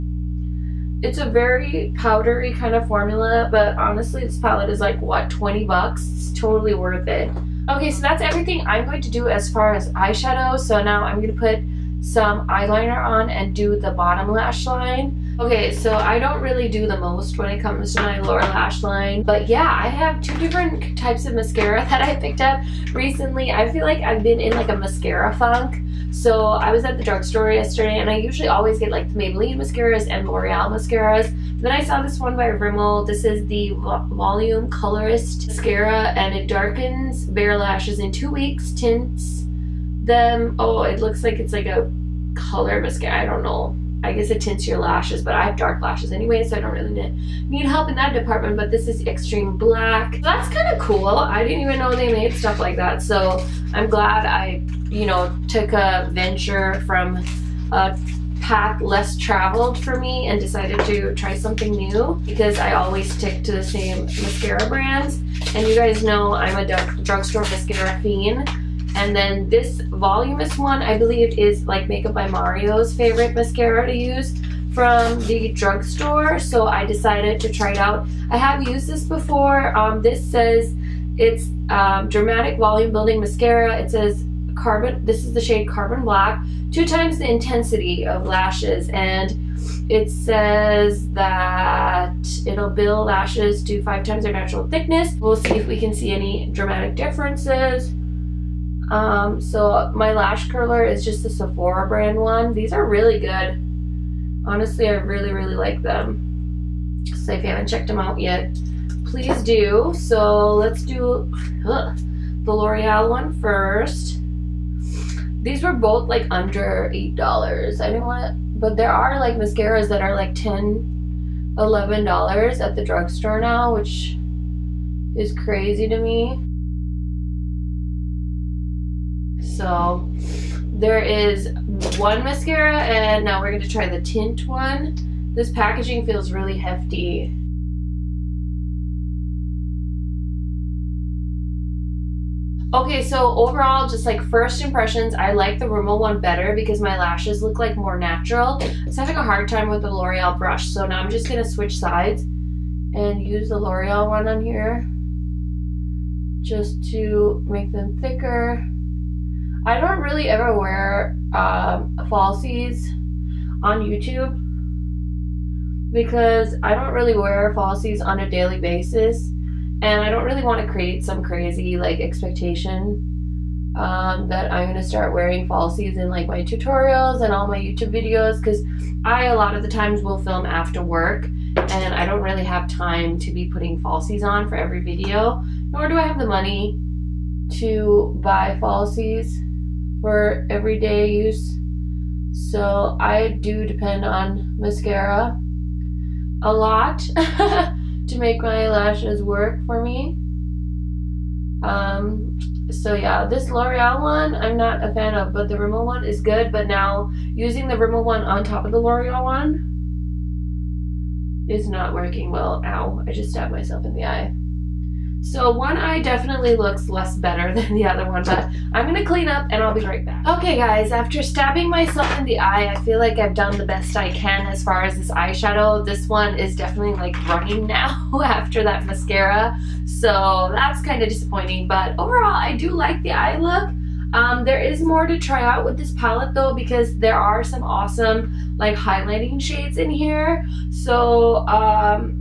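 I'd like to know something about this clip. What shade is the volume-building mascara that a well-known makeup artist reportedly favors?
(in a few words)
Carbon Black.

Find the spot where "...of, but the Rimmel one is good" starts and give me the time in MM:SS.
03:25.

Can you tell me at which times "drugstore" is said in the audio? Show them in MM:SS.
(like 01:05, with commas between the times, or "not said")
00:27, 01:07, 01:15, 02:02.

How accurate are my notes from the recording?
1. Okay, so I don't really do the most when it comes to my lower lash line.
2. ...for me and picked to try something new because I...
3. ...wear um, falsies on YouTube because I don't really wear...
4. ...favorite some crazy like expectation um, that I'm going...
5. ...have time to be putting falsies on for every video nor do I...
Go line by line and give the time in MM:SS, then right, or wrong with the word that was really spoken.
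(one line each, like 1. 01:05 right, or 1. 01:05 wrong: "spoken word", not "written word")
1. 00:15 right
2. 00:59 wrong: "decided", not "picked"
3. 02:40 right
4. 02:50 wrong: "create", not "favorite"
5. 03:02 right.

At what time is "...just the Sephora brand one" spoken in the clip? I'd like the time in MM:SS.
01:41.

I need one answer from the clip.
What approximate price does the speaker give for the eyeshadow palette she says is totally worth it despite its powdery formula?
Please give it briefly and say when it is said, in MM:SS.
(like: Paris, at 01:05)
$20, at 00:05.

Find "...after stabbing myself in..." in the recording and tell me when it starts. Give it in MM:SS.
03:40.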